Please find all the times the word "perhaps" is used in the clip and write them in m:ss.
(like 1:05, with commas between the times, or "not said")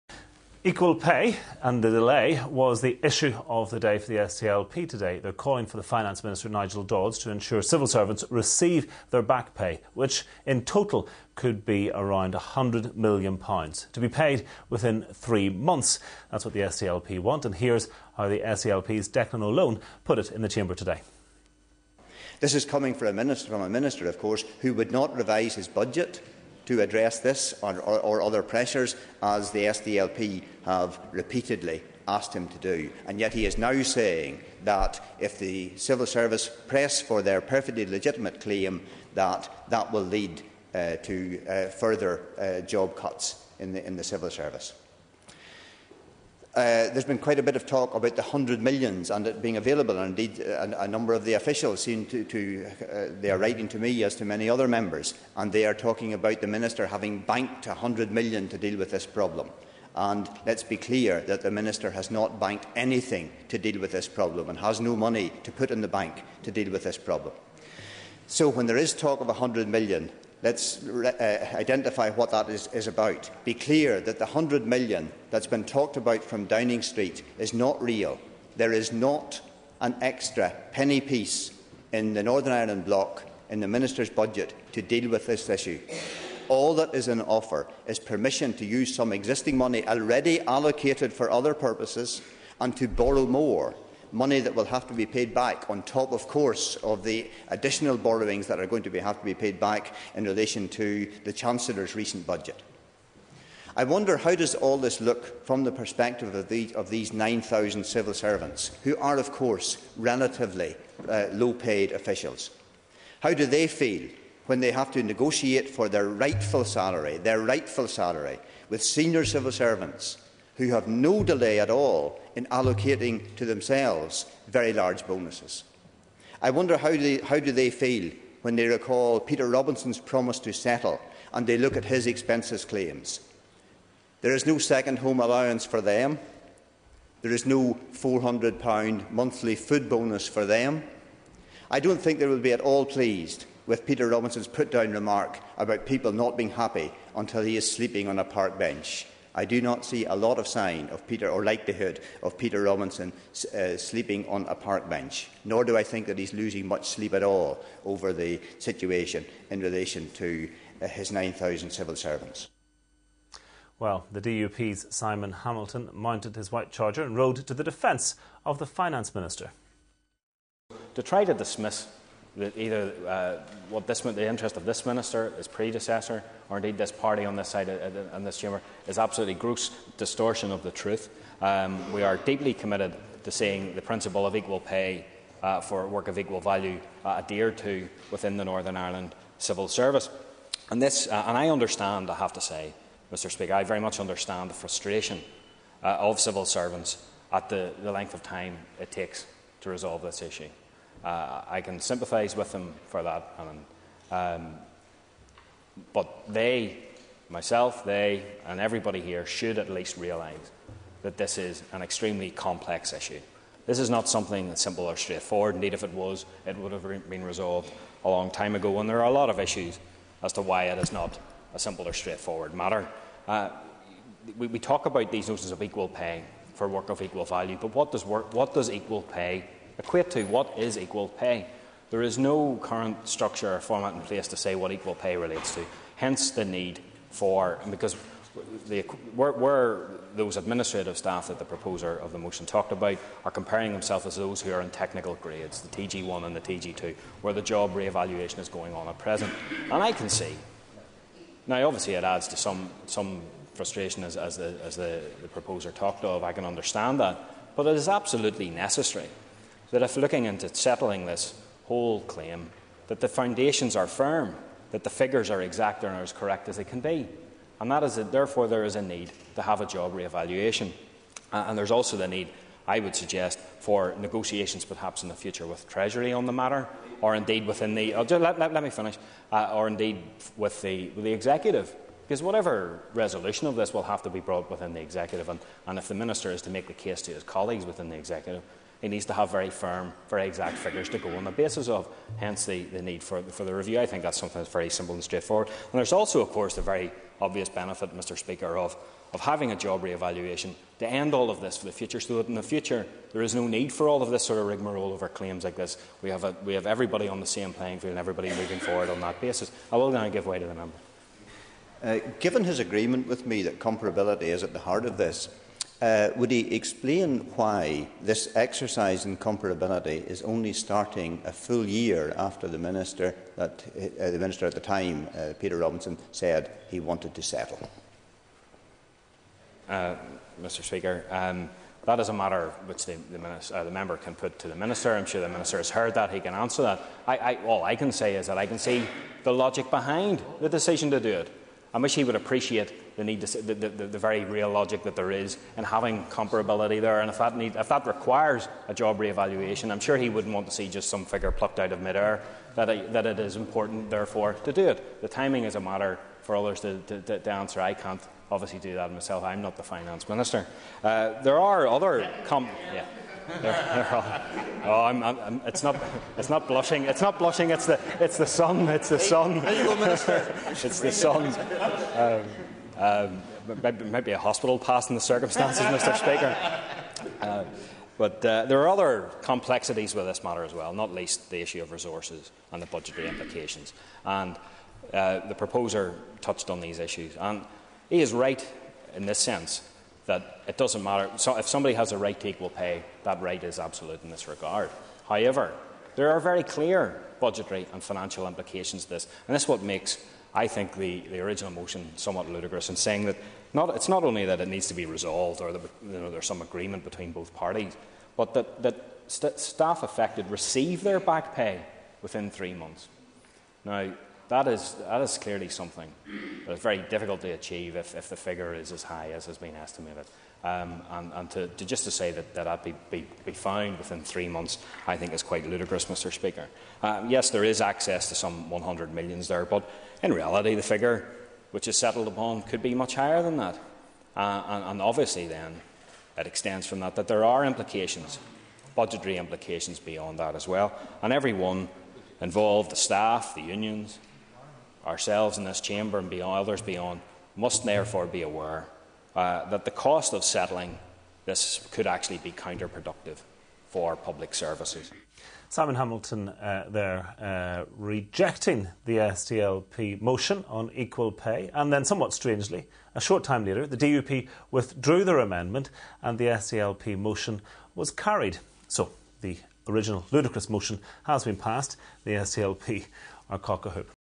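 4:34.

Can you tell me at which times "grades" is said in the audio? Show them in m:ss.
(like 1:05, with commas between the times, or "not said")
4:05.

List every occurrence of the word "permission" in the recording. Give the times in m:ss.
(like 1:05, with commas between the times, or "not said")
1:27.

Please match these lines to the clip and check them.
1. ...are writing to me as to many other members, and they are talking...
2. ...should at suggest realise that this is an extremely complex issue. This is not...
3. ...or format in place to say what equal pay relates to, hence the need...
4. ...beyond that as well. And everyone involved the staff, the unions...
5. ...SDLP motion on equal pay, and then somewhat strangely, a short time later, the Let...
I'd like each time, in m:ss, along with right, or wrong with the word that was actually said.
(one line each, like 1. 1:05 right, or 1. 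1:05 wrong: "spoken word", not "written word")
1. 0:53 right
2. 3:29 wrong: "least", not "suggest"
3. 3:53 right
4. 7:19 right
5. 7:38 wrong: "DUP", not "Let".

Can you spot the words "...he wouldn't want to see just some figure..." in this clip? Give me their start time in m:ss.
5:49.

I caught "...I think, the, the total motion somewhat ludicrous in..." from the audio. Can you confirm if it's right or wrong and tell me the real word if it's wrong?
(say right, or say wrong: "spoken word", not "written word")
wrong: "original", not "total".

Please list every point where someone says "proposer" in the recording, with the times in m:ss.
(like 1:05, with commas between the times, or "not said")
4:01, 4:15, 6:25.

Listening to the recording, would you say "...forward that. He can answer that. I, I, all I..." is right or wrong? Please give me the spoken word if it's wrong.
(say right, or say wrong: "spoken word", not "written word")
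wrong: "heard", not "forward".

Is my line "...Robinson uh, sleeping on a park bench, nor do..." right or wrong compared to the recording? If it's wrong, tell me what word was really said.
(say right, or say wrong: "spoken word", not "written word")
right.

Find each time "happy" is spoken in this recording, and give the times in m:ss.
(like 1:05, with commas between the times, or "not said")
2:26.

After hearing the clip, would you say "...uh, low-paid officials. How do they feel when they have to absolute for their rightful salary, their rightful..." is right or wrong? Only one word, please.
wrong.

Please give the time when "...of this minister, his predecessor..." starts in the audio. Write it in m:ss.
2:54.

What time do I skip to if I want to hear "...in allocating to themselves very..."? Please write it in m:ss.
2:02.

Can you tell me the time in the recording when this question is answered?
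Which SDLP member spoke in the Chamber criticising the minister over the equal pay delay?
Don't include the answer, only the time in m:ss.
0:19.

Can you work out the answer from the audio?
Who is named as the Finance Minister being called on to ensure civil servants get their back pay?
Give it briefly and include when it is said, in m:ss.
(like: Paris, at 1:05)
Nigel Dodds, at 0:06.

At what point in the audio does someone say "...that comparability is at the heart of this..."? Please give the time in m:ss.
5:13.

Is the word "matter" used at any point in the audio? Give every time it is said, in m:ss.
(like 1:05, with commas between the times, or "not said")
3:42, 4:36, 5:32, 5:55, 6:20, 6:30.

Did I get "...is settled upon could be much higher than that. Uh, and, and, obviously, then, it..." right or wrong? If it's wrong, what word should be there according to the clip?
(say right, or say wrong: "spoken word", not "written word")
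right.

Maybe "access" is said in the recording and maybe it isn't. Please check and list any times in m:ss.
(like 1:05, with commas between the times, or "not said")
7:07.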